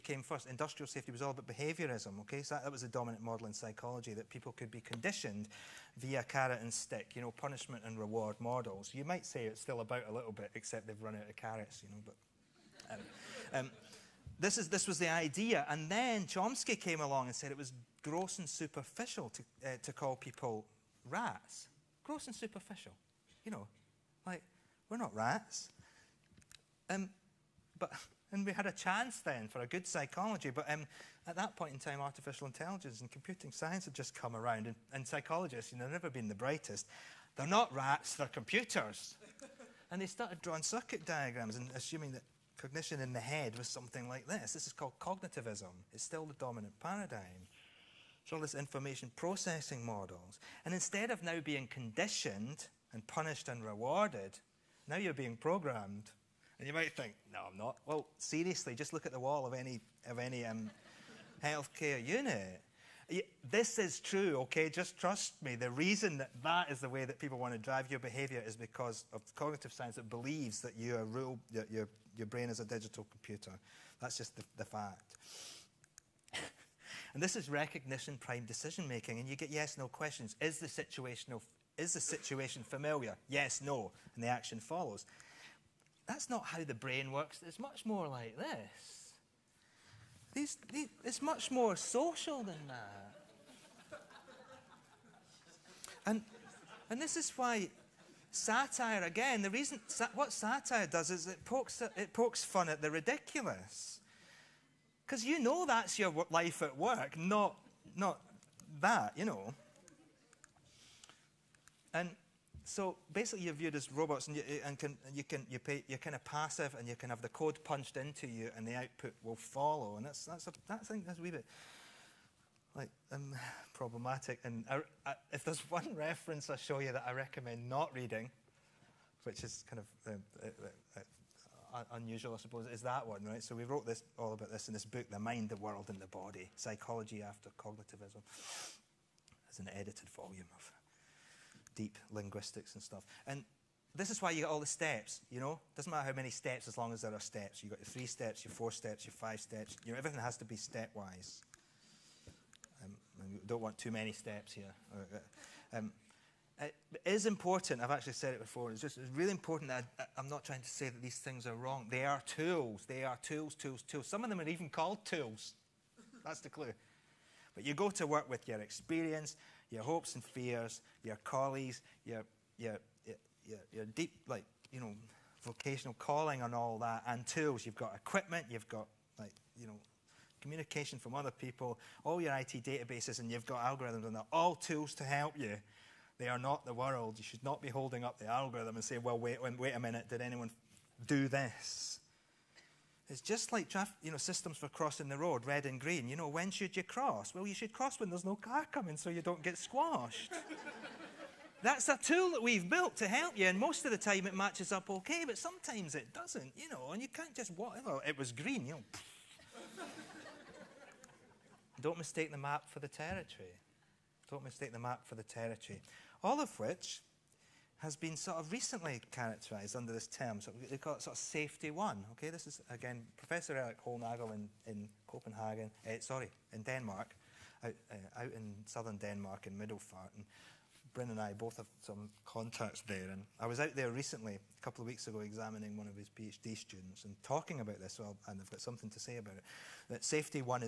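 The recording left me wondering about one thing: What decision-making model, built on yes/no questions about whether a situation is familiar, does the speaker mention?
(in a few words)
recognition prime decision making.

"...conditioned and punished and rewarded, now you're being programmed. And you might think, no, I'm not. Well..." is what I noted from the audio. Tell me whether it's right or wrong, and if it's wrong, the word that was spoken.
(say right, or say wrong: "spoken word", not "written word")
right.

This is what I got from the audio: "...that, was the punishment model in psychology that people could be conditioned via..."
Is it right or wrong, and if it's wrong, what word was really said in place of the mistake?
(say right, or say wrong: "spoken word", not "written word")
wrong: "dominant", not "punishment".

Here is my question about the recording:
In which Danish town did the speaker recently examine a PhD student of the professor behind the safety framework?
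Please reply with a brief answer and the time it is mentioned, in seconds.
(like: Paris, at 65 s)
Middelfart, at 229 s.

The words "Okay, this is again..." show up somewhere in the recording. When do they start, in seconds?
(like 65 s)
222 s.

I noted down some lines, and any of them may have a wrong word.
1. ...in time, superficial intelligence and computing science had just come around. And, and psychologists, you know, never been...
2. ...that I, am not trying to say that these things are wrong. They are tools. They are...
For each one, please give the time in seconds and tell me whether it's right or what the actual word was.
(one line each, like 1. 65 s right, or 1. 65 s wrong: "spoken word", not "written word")
1. 31 s wrong: "artificial", not "superficial"
2. 159 s right.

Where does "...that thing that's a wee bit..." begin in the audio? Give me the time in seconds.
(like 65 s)
120 s.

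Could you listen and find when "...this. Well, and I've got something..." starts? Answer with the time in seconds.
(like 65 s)
237 s.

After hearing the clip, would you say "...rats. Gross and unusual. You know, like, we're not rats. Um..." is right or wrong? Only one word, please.
wrong.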